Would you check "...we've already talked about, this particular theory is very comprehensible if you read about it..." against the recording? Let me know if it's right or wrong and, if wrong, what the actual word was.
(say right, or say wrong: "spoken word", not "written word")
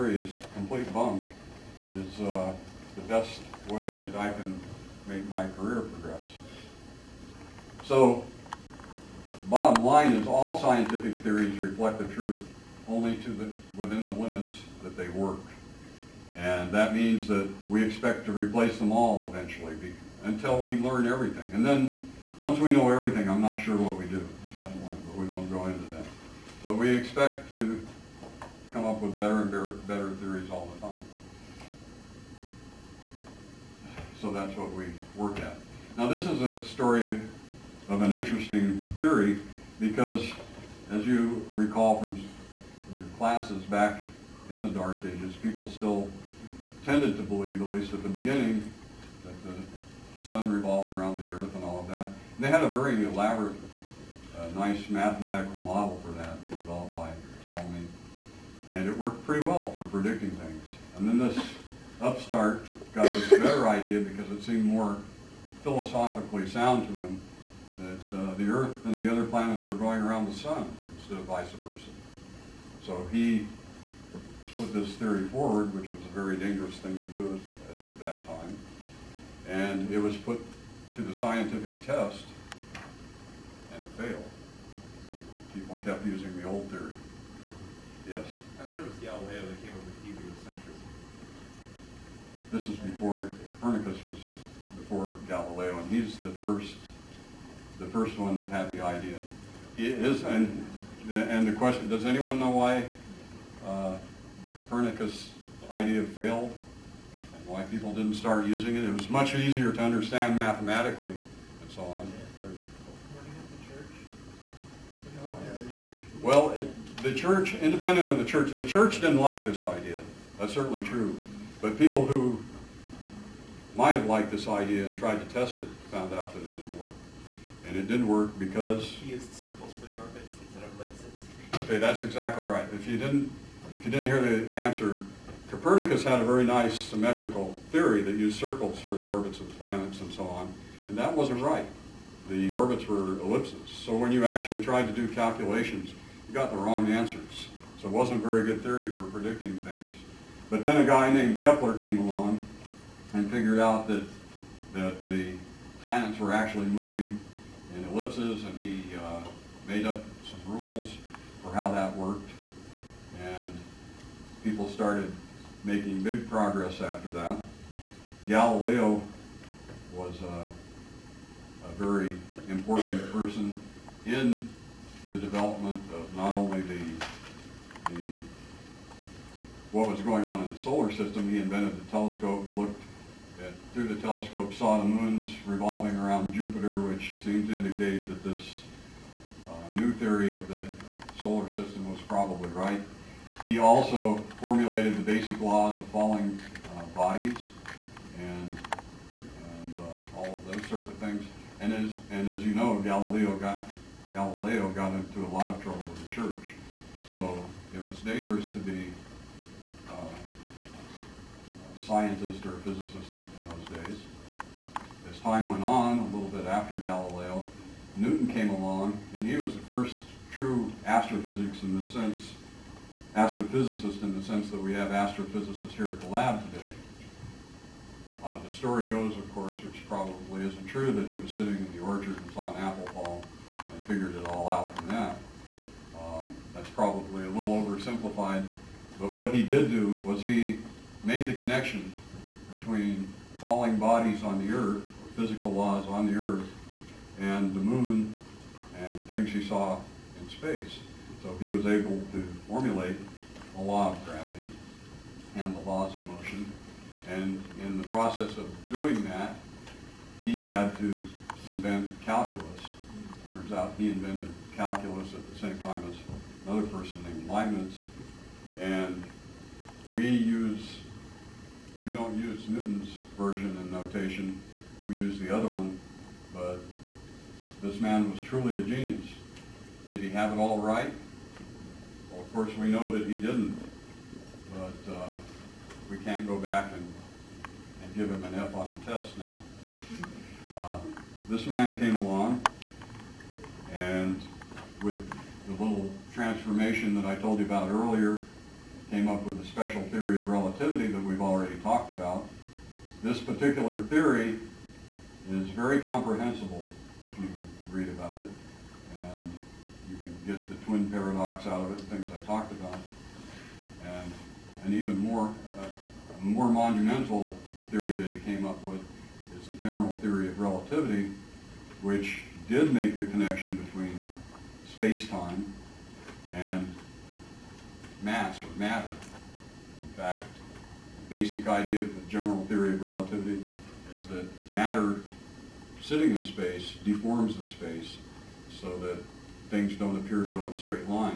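right.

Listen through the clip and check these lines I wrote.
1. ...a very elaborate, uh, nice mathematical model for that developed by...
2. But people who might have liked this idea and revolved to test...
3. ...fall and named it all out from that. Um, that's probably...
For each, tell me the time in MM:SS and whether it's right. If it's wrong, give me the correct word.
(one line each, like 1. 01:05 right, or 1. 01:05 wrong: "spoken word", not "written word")
1. 00:52 right
2. 02:01 wrong: "tried", not "revolved"
3. 03:52 wrong: "figured", not "named".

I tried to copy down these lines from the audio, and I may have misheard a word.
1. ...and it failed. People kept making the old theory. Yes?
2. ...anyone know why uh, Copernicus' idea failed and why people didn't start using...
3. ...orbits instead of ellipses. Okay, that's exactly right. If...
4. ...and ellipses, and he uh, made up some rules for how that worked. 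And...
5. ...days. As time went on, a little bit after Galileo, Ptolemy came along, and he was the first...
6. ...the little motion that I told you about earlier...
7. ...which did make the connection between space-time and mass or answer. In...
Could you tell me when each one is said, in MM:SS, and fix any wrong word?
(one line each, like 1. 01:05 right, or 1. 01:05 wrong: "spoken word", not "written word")
1. 01:23 wrong: "using", not "making"
2. 01:42 right
3. 02:09 right
4. 02:37 right
5. 03:33 wrong: "Newton", not "Ptolemy"
6. 04:55 wrong: "transformation", not "motion"
7. 05:21 wrong: "matter", not "answer".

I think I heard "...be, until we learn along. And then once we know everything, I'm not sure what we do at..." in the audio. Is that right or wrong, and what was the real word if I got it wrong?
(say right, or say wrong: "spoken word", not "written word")
wrong: "everything", not "along".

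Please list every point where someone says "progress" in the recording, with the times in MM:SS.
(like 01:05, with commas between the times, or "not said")
00:05, 02:46.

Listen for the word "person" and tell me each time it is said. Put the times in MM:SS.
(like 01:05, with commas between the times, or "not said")
02:53, 04:26.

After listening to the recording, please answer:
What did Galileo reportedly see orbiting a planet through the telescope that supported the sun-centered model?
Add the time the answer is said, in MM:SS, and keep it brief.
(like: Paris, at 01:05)
Moons revolving around Jupiter, at 03:04.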